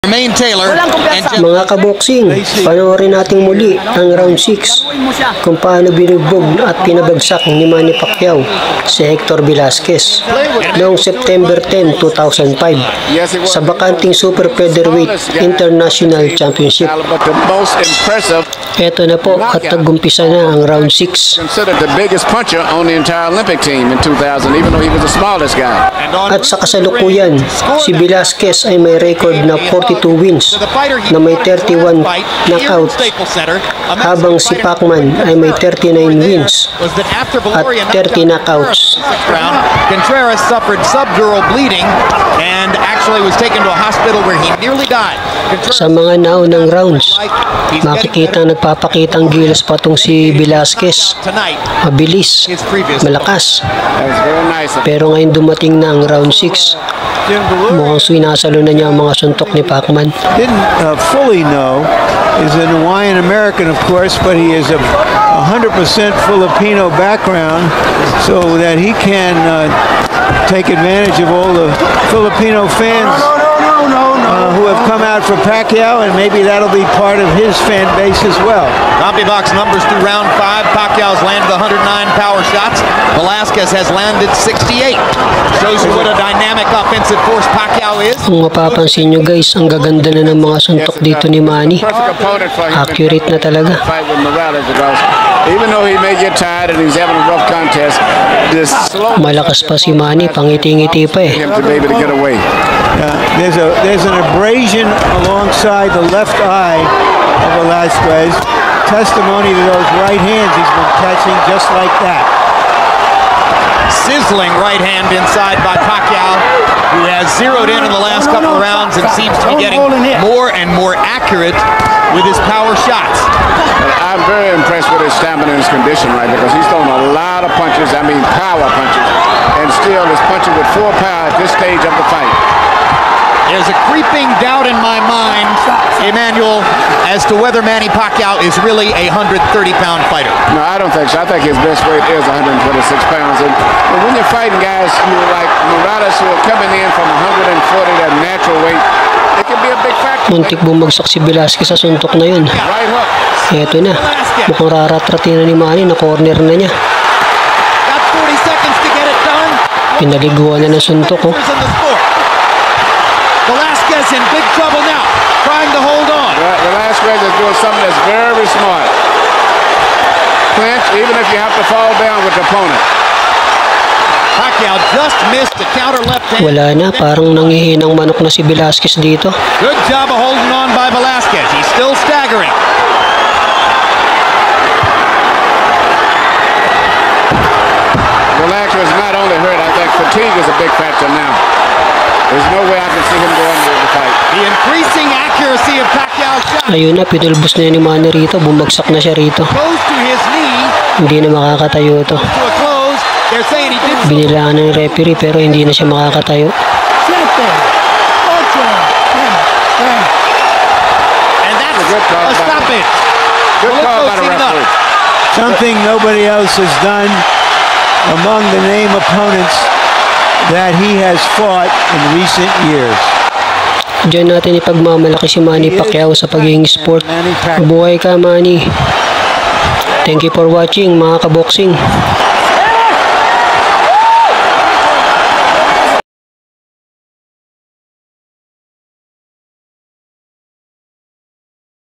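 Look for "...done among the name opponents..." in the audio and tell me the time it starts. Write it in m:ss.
3:36.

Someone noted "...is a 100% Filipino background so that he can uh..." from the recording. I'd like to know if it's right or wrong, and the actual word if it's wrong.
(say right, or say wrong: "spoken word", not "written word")
right.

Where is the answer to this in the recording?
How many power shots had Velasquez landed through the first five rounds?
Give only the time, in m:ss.
1:24.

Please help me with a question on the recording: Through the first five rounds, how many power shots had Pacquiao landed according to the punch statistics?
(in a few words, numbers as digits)
109.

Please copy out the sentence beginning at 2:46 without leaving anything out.
Right, doing something that's very smart.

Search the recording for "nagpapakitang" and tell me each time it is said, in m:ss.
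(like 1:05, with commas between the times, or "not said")
0:48.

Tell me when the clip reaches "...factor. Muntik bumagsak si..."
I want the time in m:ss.
2:29.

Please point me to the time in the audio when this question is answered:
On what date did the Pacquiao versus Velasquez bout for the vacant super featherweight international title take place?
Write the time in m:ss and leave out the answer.
0:10.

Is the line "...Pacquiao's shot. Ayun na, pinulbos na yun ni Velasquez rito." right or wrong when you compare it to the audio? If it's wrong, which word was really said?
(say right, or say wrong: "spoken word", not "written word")
wrong: "Manny", not "Velasquez".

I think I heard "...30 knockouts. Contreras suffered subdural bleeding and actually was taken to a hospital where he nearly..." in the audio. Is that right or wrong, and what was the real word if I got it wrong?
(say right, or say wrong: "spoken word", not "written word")
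right.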